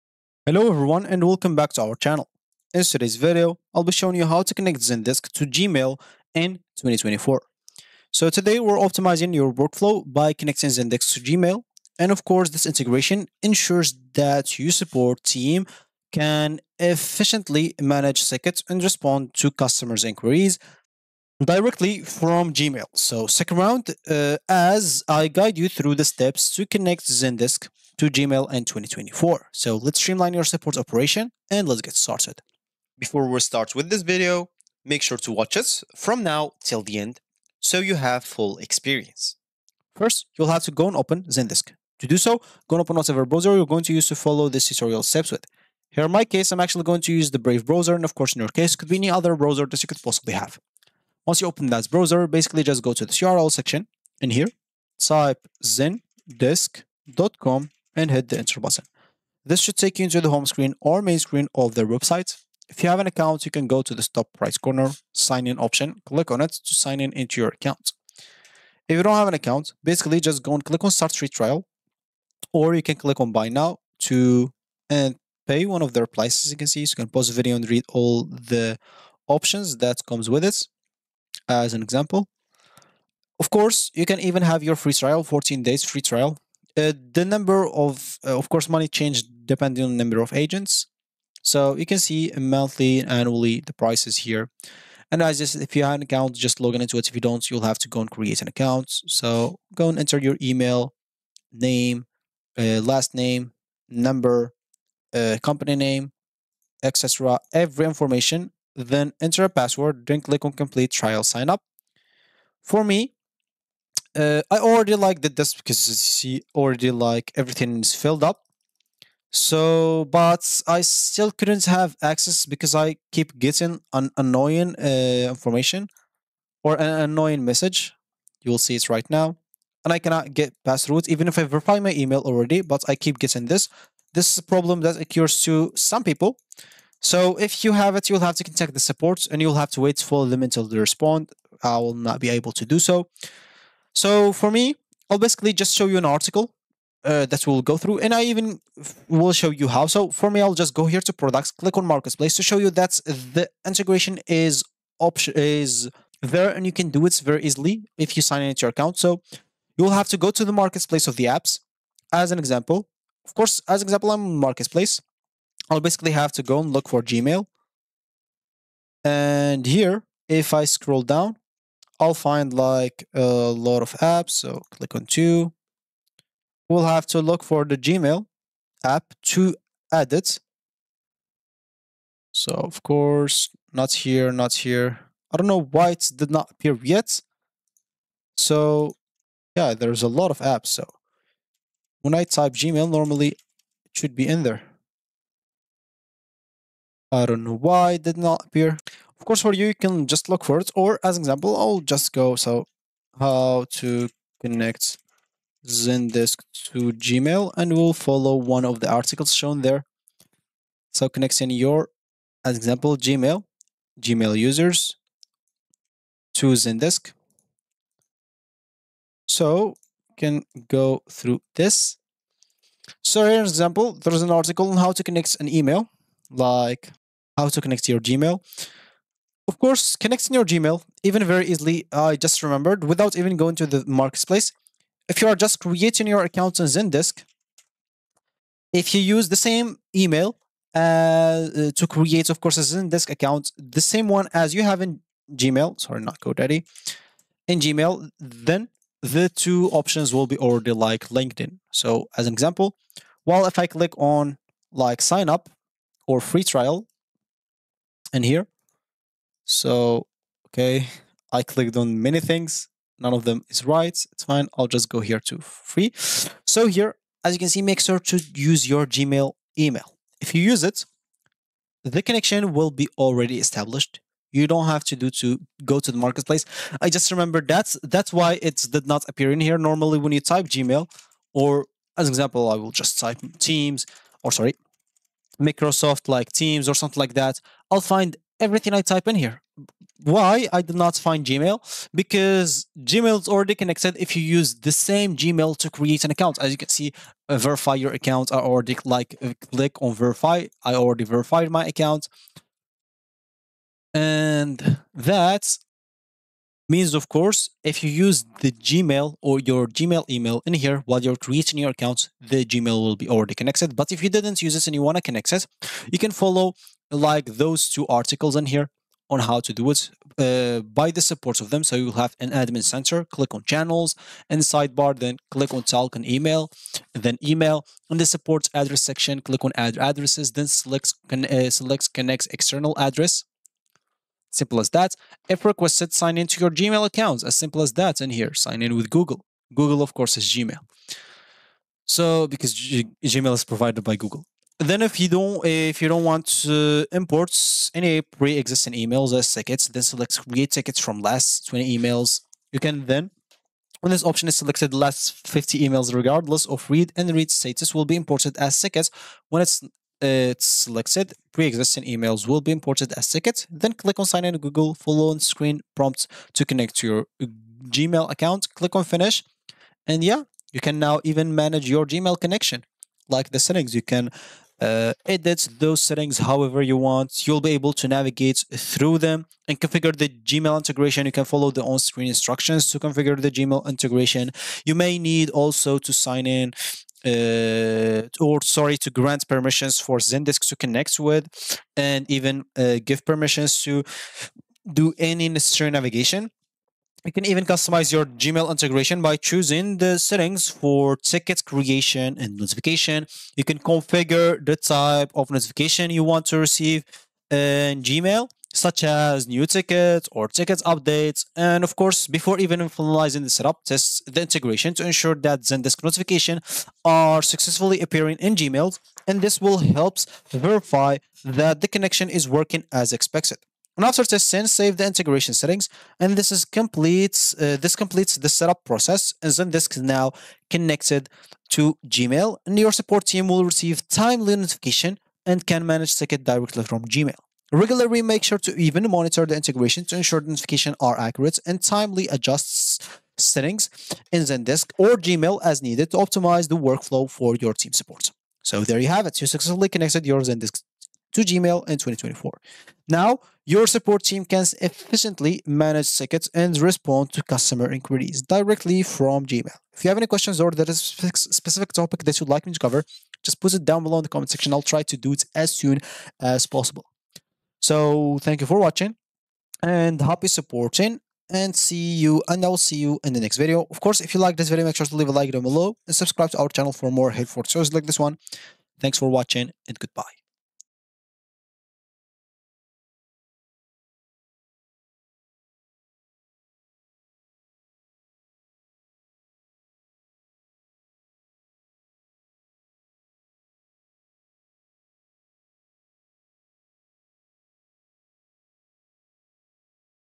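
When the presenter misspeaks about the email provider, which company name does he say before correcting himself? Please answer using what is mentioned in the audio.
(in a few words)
GoDaddy.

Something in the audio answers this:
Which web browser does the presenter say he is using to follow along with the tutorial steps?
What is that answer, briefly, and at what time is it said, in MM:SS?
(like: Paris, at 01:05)
Brave, at 00:47.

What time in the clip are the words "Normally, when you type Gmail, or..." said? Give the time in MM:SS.
04:39.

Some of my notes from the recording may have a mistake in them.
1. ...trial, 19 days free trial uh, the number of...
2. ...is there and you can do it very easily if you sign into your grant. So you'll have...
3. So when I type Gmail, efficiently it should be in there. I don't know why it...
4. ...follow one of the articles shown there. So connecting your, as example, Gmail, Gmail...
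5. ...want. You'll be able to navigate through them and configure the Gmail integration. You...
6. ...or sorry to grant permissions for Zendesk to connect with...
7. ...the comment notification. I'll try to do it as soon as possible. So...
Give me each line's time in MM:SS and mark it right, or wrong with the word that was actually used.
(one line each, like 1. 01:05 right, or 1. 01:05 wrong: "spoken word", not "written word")
1. 01:24 wrong: "14", not "19"
2. 02:35 wrong: "account", not "grant"
3. 03:10 wrong: "normally", not "efficiently"
4. 03:27 right
5. 06:16 right
6. 06:28 right
7. 07:44 wrong: "section", not "notification".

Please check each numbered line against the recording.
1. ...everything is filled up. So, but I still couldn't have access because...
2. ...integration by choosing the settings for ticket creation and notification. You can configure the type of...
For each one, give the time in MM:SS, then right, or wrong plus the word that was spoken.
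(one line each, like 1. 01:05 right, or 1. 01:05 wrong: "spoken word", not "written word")
1. 01:57 right
2. 06:38 right.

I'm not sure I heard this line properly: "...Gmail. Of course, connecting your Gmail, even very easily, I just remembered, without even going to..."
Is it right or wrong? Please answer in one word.
right.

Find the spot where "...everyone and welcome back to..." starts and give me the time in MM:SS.
00:00.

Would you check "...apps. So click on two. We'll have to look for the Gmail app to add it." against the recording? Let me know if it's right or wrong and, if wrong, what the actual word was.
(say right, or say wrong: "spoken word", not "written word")
right.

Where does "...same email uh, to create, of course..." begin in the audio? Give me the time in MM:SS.
03:59.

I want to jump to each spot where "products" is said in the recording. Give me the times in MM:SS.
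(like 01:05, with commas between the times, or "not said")
02:31.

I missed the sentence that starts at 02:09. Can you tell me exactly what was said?
And I cannot get past root even if I verify my email already, but I keep getting this.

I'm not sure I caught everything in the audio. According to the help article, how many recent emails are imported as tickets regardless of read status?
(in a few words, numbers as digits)
50.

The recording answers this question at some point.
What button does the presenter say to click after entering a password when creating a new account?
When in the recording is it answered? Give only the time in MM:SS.
01:50.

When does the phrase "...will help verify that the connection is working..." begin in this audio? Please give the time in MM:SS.
06:59.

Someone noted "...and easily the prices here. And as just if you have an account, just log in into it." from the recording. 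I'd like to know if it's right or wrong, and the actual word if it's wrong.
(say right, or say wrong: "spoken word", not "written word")
wrong: "annually", not "easily".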